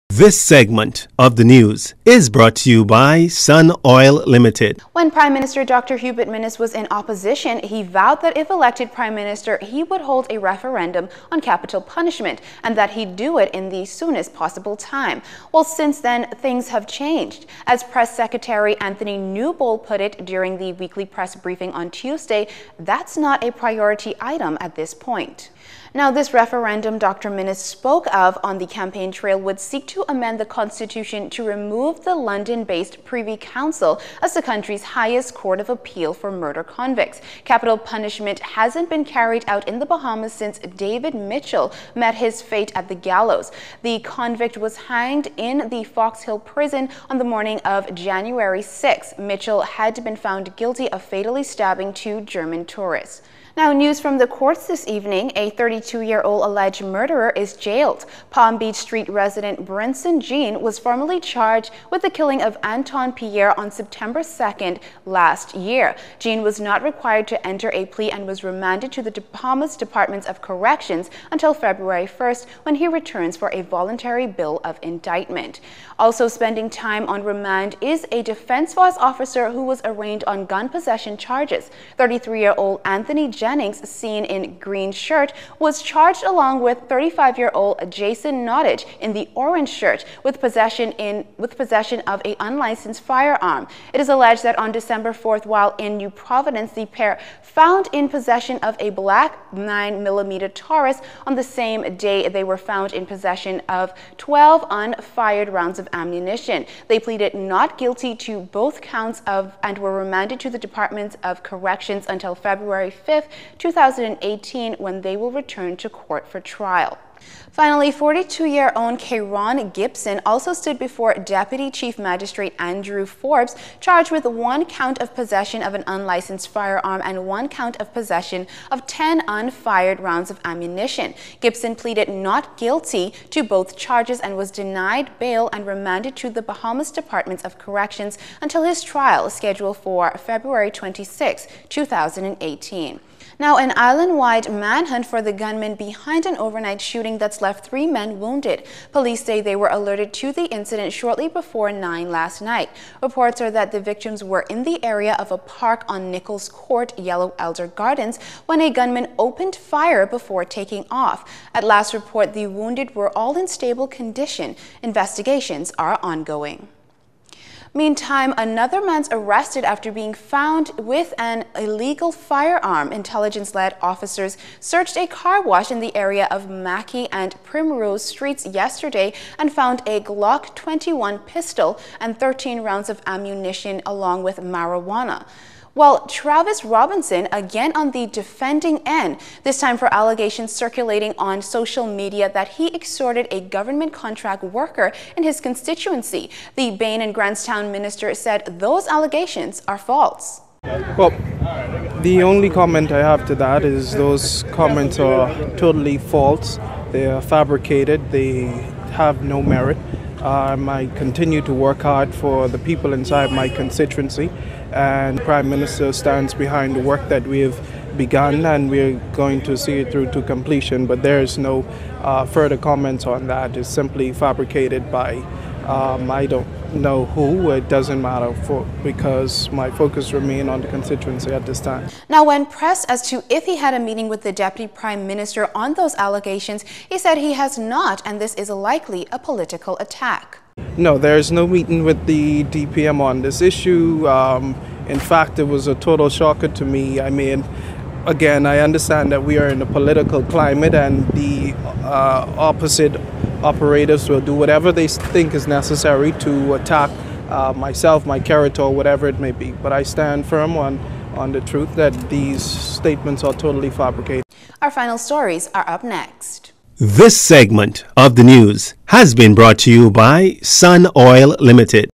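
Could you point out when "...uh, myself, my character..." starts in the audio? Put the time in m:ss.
4:17.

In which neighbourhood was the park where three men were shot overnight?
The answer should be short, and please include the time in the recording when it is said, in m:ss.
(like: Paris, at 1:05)
Yellow Elder Gardens, at 2:36.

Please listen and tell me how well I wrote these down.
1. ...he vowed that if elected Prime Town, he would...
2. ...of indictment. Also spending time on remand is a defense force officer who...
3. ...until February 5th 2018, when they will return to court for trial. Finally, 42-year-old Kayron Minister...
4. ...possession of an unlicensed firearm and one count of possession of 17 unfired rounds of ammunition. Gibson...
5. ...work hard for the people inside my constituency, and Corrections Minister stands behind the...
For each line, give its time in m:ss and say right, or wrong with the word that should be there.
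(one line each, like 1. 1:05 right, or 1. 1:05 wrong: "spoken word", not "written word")
1. 0:07 wrong: "Minister", not "Town"
2. 1:14 right
3. 1:52 wrong: "Gibson", not "Minister"
4. 2:05 wrong: "10", not "17"
5. 3:31 wrong: "Prime", not "Corrections".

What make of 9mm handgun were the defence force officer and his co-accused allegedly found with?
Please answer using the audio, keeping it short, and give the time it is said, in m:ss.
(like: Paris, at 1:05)
Taurus, at 1:40.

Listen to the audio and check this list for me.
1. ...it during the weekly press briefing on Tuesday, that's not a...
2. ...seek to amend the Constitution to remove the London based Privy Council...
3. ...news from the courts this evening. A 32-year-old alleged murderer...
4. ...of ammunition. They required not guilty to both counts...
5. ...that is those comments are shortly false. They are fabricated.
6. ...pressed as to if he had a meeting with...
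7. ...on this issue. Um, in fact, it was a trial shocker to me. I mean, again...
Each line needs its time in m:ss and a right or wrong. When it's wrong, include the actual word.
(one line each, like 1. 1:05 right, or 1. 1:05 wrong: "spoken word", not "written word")
1. 0:20 right
2. 0:29 right
3. 0:53 right
4. 1:45 wrong: "pleaded", not "required"
5. 3:23 wrong: "totally", not "shortly"
6. 3:52 right
7. 4:02 wrong: "total", not "trial".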